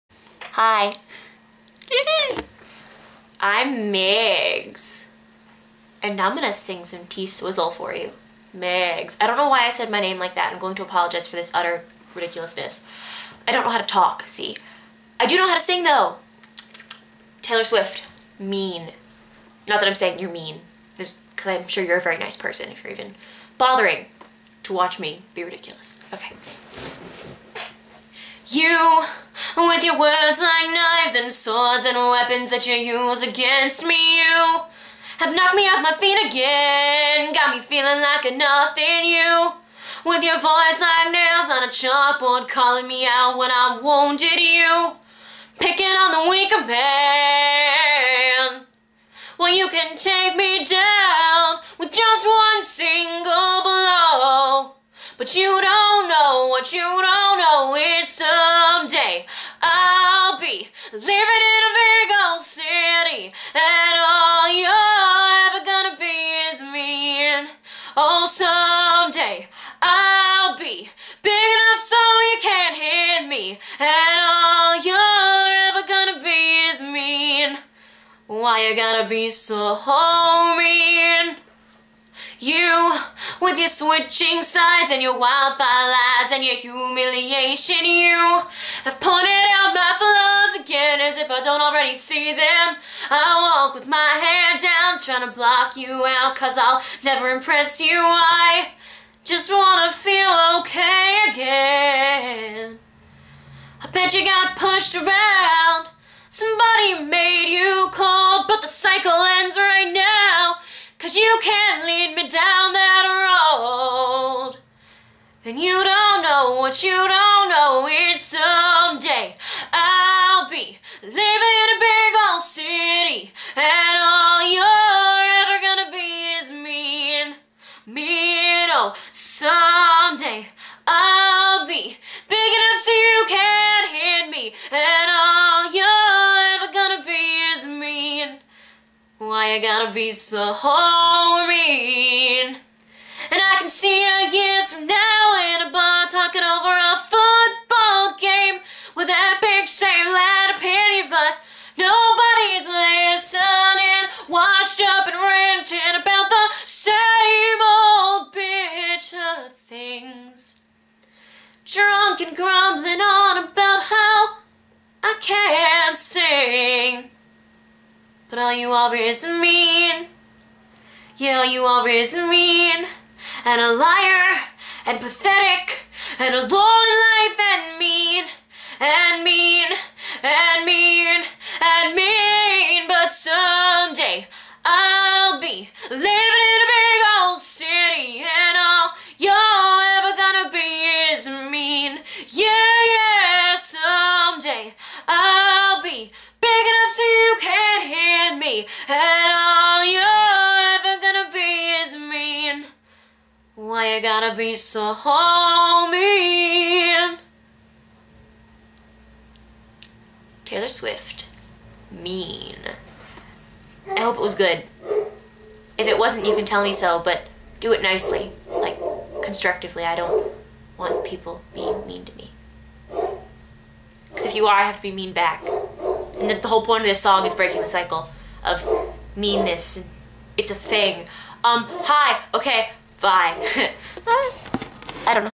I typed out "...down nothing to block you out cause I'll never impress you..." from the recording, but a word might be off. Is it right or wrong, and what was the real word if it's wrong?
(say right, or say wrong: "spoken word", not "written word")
wrong: "trying", not "nothing".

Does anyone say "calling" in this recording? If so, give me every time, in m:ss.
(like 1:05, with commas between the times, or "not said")
0:42.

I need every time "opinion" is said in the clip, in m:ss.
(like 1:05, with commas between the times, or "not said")
2:30.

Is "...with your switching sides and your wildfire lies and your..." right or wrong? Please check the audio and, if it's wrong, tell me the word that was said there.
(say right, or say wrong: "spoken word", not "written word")
right.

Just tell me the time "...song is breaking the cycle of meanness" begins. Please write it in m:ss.
3:47.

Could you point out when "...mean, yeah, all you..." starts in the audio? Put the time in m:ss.
2:49.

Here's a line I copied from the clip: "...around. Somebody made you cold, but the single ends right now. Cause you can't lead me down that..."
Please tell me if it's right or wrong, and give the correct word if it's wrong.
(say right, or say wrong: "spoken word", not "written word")
wrong: "cycle", not "single".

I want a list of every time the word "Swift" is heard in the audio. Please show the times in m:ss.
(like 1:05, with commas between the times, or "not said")
0:17, 3:30.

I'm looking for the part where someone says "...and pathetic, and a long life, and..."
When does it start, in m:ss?
2:54.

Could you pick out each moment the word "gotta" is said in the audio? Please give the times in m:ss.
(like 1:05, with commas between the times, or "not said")
1:18, 2:19, 3:24.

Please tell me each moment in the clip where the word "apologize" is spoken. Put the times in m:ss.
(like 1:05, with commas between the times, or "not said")
0:10.